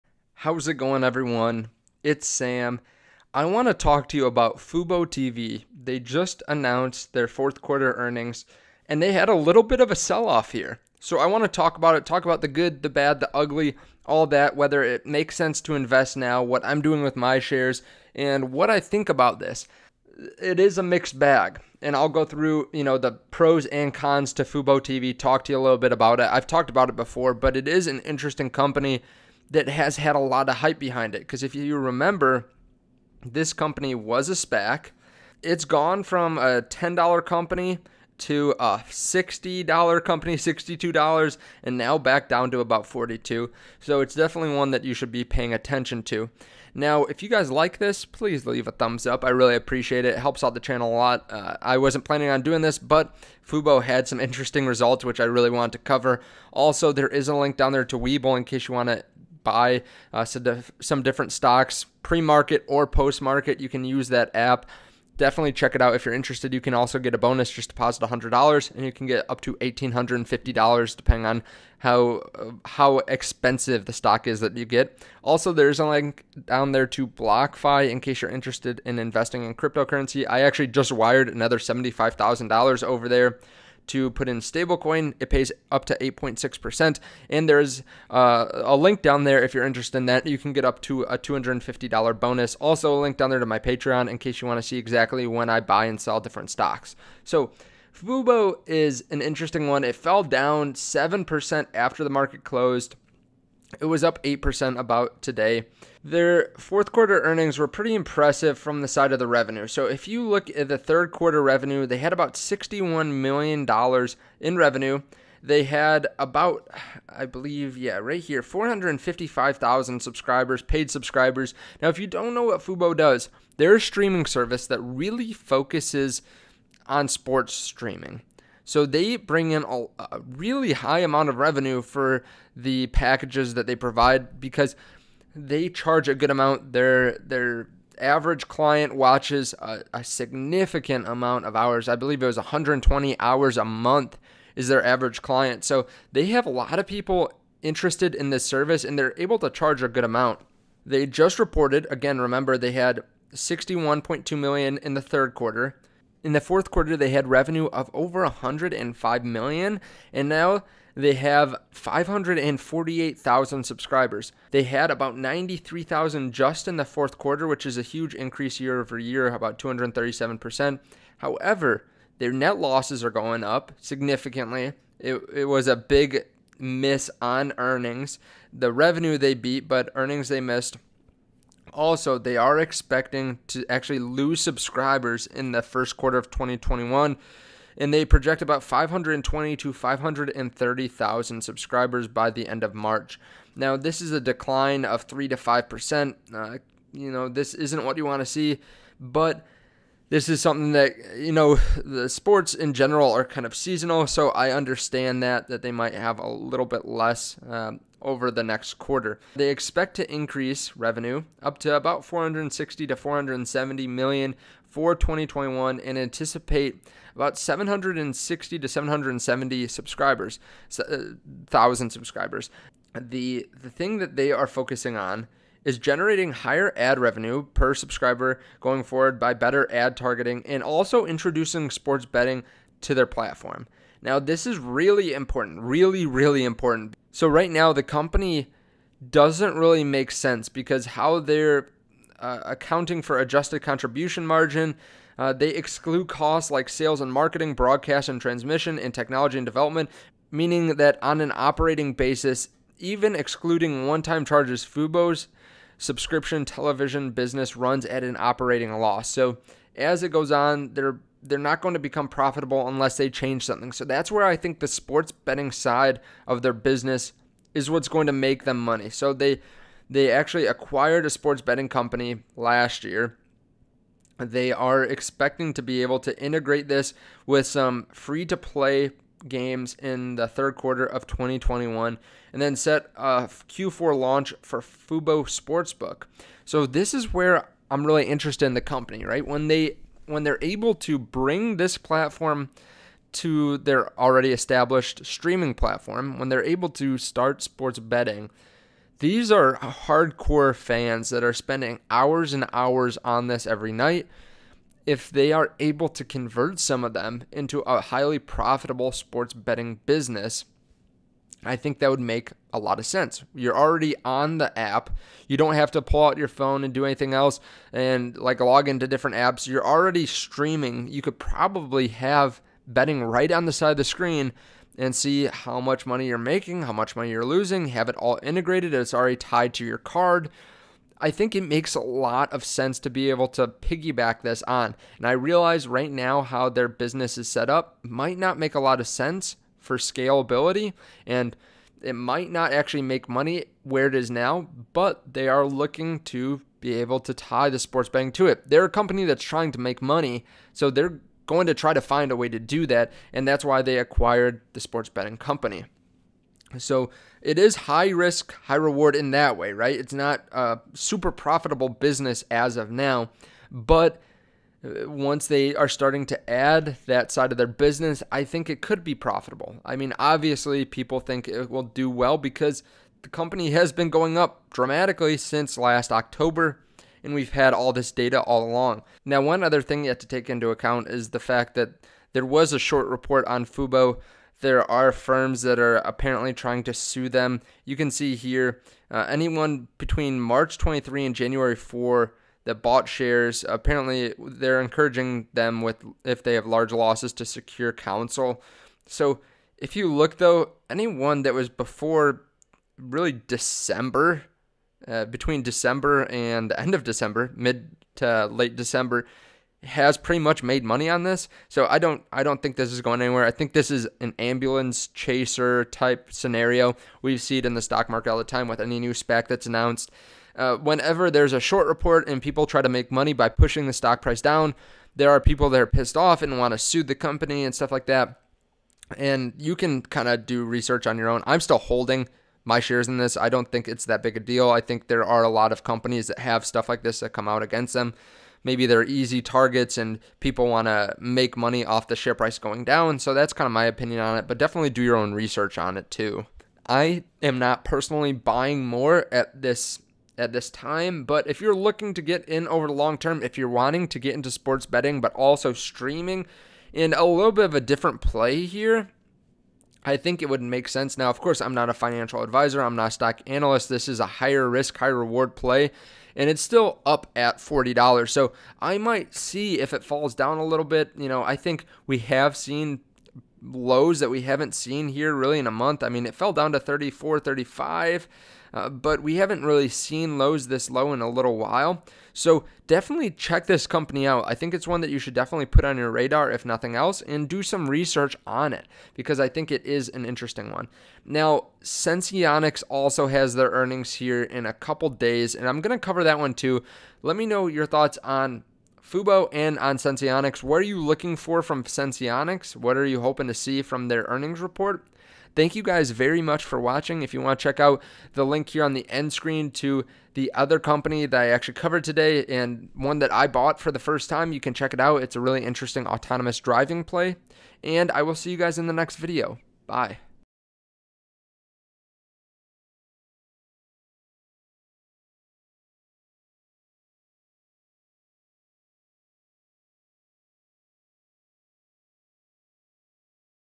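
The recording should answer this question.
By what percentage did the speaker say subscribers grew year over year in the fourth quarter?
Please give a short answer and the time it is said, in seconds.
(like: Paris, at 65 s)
237%, at 169 s.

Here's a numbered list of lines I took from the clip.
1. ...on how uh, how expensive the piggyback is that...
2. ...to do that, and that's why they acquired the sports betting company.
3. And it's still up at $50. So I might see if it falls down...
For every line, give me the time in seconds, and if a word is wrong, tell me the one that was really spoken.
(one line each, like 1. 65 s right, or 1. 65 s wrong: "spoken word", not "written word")
1. 71 s wrong: "stock", not "piggyback"
2. 352 s right
3. 466 s wrong: "40", not "50".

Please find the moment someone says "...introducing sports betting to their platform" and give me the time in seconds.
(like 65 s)
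231 s.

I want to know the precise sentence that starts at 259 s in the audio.
So, as it goes on, they're they're not going to become profitable unless they change something.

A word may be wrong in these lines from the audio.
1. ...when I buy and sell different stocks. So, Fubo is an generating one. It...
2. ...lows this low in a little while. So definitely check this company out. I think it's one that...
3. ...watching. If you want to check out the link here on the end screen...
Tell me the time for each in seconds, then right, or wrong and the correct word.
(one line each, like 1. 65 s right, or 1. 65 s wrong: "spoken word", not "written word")
1. 95 s wrong: "interesting", not "generating"
2. 480 s right
3. 506 s right.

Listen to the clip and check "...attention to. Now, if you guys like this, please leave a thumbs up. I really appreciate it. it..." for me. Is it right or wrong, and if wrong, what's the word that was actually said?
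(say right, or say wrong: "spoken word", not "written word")
right.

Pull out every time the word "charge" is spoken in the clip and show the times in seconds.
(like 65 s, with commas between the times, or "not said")
135 s, 149 s, 254 s.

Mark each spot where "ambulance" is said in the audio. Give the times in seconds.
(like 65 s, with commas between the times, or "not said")
414 s.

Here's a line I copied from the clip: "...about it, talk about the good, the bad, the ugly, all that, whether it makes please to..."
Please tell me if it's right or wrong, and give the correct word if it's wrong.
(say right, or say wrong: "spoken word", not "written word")
wrong: "sense", not "please".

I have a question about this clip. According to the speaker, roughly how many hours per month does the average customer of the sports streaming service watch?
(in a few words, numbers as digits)
120 hours.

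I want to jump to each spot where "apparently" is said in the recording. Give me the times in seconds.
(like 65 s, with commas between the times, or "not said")
385 s, 393 s.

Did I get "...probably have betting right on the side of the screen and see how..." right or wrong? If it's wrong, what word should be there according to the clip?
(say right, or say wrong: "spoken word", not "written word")
right.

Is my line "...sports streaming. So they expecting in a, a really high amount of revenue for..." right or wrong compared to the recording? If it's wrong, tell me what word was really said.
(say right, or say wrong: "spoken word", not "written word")
wrong: "bring", not "expecting".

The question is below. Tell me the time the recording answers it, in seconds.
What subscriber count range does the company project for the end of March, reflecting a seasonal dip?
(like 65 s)
188 s.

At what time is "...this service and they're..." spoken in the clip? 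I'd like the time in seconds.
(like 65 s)
148 s.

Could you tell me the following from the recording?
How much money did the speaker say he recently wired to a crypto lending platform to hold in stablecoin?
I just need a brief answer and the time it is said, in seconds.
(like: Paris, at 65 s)
$75,000, at 81 s.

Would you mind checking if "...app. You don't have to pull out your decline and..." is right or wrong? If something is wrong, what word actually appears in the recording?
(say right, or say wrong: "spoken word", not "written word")
wrong: "phone", not "decline".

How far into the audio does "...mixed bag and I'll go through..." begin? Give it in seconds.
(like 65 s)
20 s.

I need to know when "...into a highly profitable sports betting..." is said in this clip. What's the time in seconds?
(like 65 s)
307 s.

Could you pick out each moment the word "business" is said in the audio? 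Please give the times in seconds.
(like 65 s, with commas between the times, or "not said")
257 s, 266 s, 309 s, 336 s, 361 s, 367 s.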